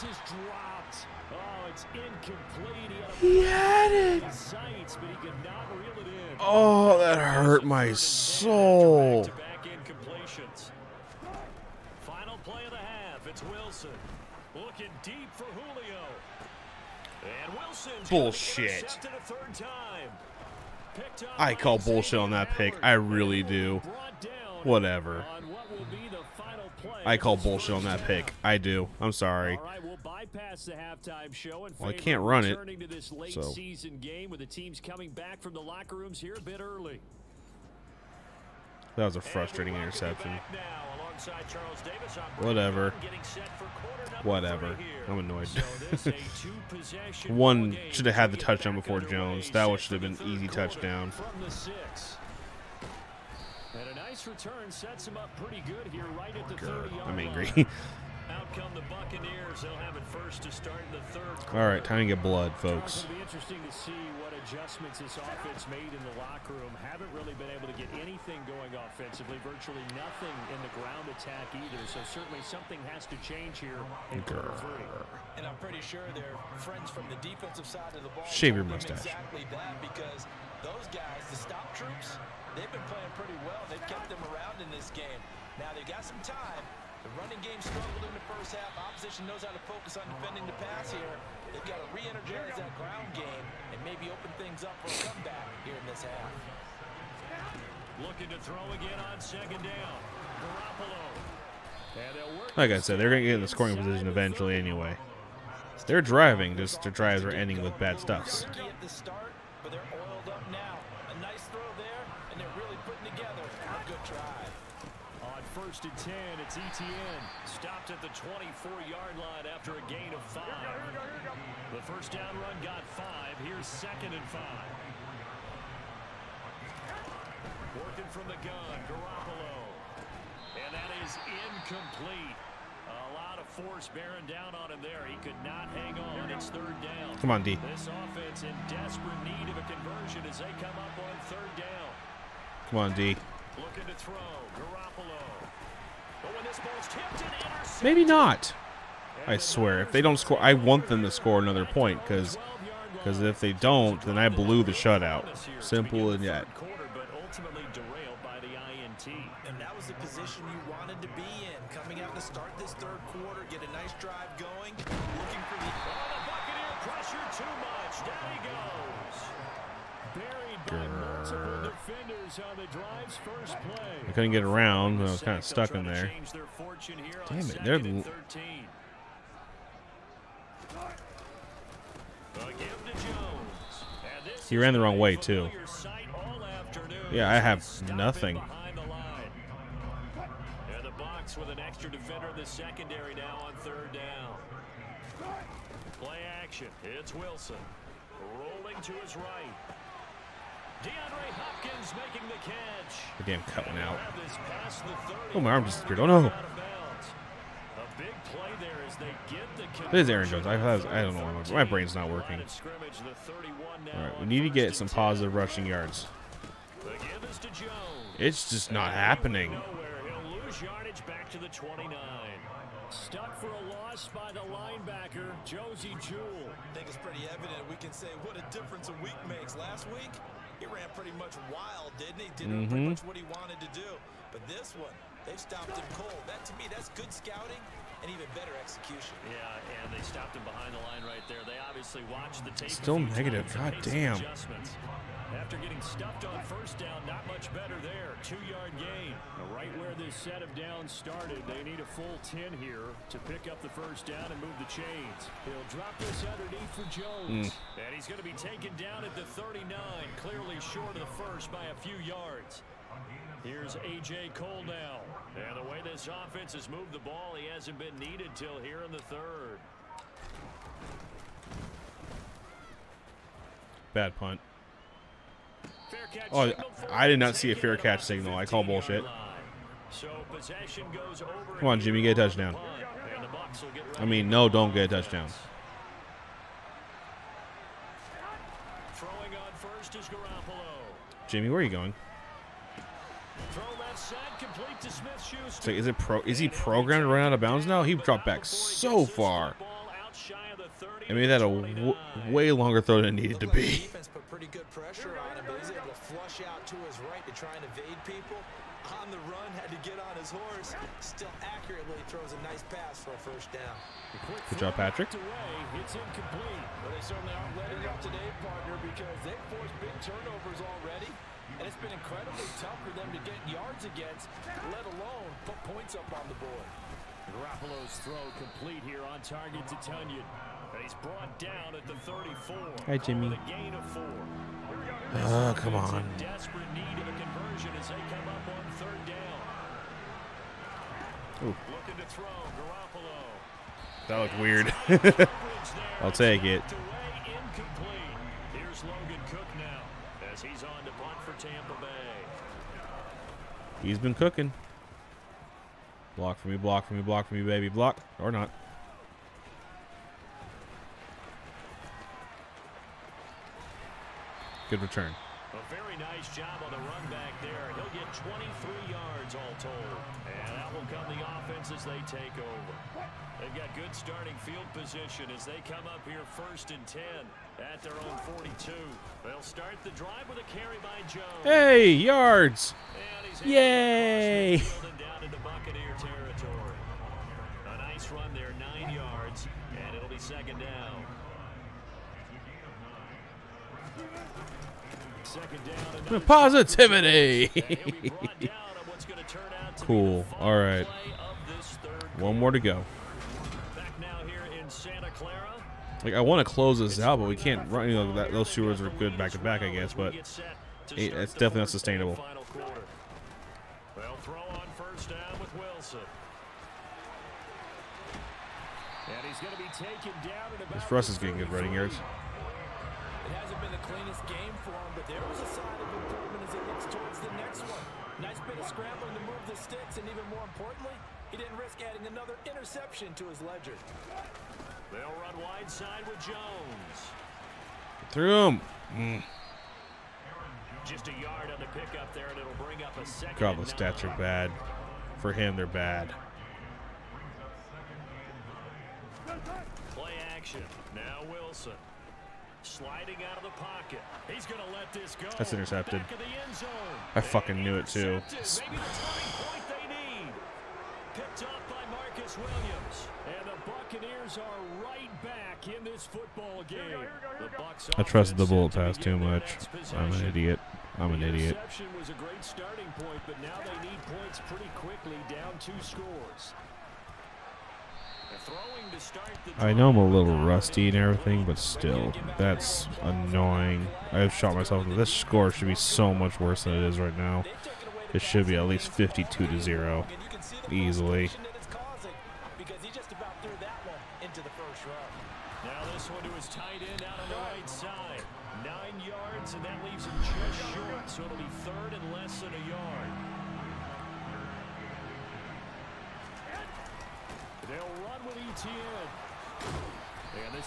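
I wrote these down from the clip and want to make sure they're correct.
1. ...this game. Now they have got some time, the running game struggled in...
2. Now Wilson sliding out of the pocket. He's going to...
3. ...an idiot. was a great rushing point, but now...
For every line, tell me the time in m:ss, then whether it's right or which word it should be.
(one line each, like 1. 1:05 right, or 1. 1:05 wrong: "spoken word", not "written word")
1. 1:24 right
2. 7:30 right
3. 7:51 wrong: "starting", not "rushing".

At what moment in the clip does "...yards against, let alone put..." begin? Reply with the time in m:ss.
5:23.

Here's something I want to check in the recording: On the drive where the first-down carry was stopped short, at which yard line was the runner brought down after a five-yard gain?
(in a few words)
24.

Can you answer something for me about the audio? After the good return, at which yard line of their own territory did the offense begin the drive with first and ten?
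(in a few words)
42.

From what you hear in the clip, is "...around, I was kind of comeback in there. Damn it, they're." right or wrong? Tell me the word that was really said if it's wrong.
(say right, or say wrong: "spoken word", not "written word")
wrong: "stuck", not "comeback".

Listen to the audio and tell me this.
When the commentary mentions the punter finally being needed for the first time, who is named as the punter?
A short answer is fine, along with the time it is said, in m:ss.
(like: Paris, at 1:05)
A.J. Cole, at 4:23.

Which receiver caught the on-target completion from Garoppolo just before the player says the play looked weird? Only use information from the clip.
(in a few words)
Tonyan.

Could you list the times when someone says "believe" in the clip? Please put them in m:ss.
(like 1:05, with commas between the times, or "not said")
not said.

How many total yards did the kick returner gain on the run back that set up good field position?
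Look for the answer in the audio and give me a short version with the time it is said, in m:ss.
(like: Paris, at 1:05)
23, at 6:08.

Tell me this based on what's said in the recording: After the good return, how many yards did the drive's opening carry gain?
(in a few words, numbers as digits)
9.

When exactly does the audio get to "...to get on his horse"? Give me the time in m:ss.
5:09.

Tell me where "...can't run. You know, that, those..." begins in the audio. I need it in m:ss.
6:47.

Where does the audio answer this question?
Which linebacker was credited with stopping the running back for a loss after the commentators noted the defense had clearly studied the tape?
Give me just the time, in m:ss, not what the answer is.
3:45.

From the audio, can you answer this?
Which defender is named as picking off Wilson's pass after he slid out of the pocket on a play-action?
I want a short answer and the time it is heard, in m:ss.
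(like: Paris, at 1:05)
Marcus Williams, at 7:41.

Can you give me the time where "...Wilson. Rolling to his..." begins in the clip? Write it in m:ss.
3:17.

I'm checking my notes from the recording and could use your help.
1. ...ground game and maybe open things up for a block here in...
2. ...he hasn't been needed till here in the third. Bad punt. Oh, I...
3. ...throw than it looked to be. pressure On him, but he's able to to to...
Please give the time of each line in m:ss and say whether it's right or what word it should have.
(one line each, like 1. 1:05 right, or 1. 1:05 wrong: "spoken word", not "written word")
1. 1:32 wrong: "comeback", not "block"
2. 4:27 right
3. 5:02 wrong: "needed", not "looked".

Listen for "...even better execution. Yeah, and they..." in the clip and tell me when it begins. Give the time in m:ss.
3:58.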